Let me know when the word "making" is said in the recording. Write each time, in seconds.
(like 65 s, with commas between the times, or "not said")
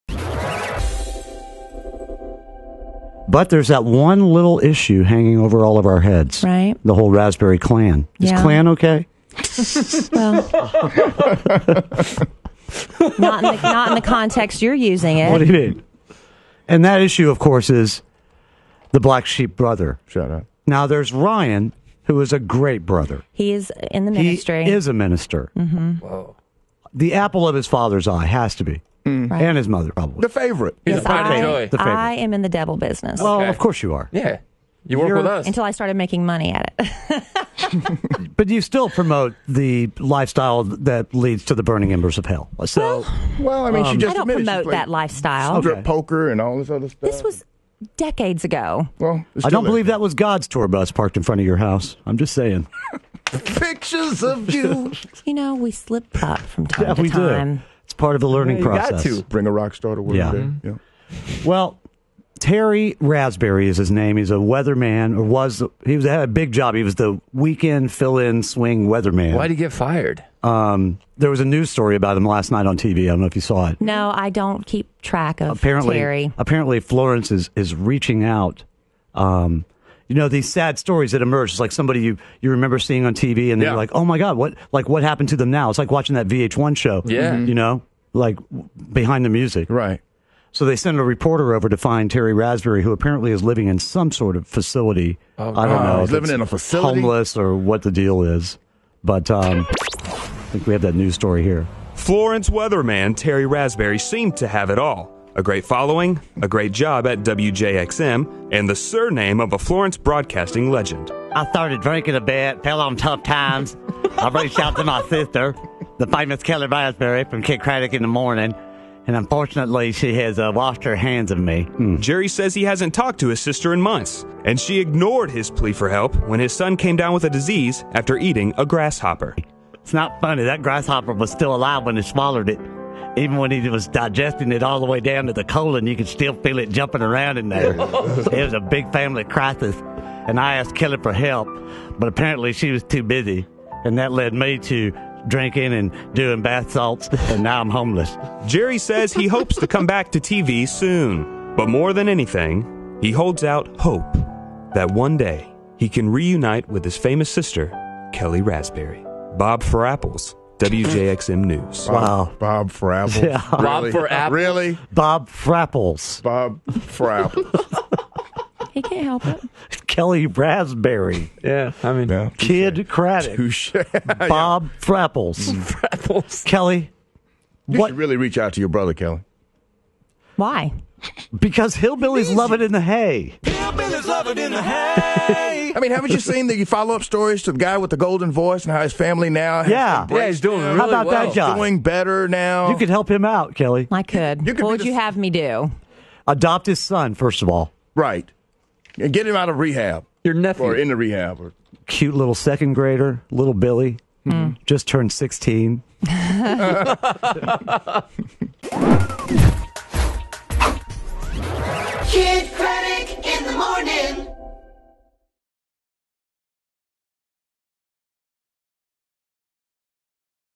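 35 s.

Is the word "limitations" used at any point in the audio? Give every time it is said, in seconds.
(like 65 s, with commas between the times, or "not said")
not said.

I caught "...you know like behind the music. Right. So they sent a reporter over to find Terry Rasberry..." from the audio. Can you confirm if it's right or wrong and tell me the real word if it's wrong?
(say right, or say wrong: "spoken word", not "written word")
right.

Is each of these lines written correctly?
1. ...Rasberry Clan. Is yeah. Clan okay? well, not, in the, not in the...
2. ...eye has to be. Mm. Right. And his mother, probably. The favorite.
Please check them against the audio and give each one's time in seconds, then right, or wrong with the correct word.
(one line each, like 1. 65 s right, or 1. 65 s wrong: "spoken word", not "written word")
1. 7 s right
2. 28 s right.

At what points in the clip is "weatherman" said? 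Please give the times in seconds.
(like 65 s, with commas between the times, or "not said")
64 s, 68 s, 102 s.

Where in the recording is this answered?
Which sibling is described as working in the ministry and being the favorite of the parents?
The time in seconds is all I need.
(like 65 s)
21 s.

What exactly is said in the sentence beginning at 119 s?
And unfortunately, she has uh, washed her hands of me.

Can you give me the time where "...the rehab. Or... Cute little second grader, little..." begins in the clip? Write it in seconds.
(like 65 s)
200 s.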